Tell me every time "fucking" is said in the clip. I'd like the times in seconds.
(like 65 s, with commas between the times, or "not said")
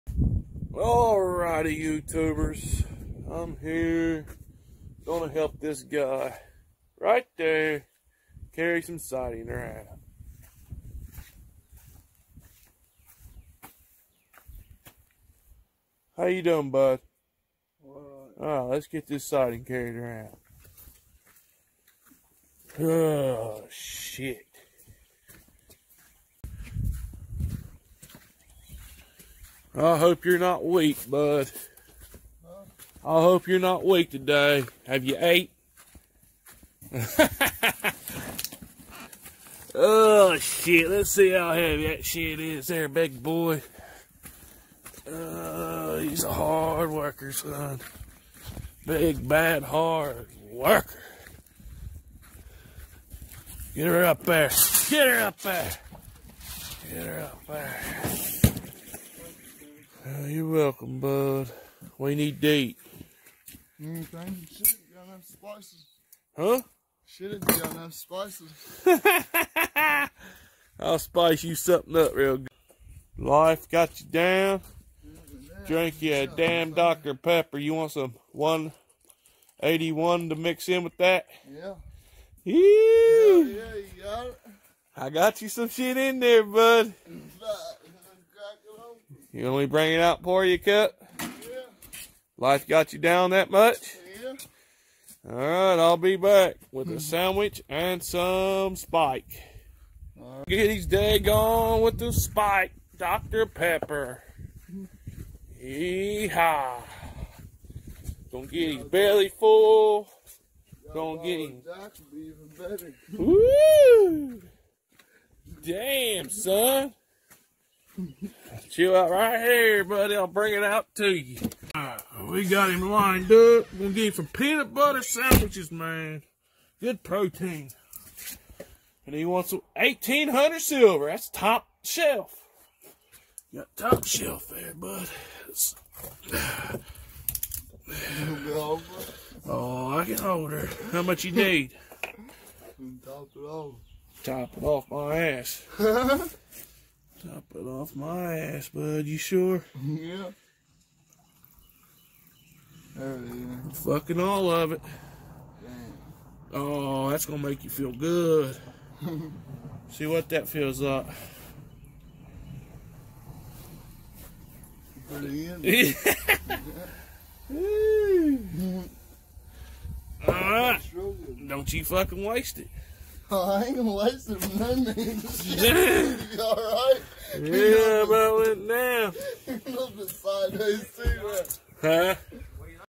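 153 s, 171 s.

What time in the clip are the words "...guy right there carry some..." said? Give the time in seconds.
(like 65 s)
5 s.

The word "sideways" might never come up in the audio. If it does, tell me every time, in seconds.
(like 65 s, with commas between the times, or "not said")
180 s.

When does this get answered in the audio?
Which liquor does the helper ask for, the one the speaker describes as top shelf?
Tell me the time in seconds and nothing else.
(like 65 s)
129 s.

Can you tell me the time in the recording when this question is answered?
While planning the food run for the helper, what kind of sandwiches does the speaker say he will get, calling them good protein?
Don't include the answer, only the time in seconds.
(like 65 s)
124 s.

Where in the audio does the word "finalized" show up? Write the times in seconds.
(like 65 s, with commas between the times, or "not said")
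not said.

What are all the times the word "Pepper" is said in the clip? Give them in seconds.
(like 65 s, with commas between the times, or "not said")
77 s, 103 s.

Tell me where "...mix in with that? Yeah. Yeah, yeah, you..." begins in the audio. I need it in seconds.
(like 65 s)
80 s.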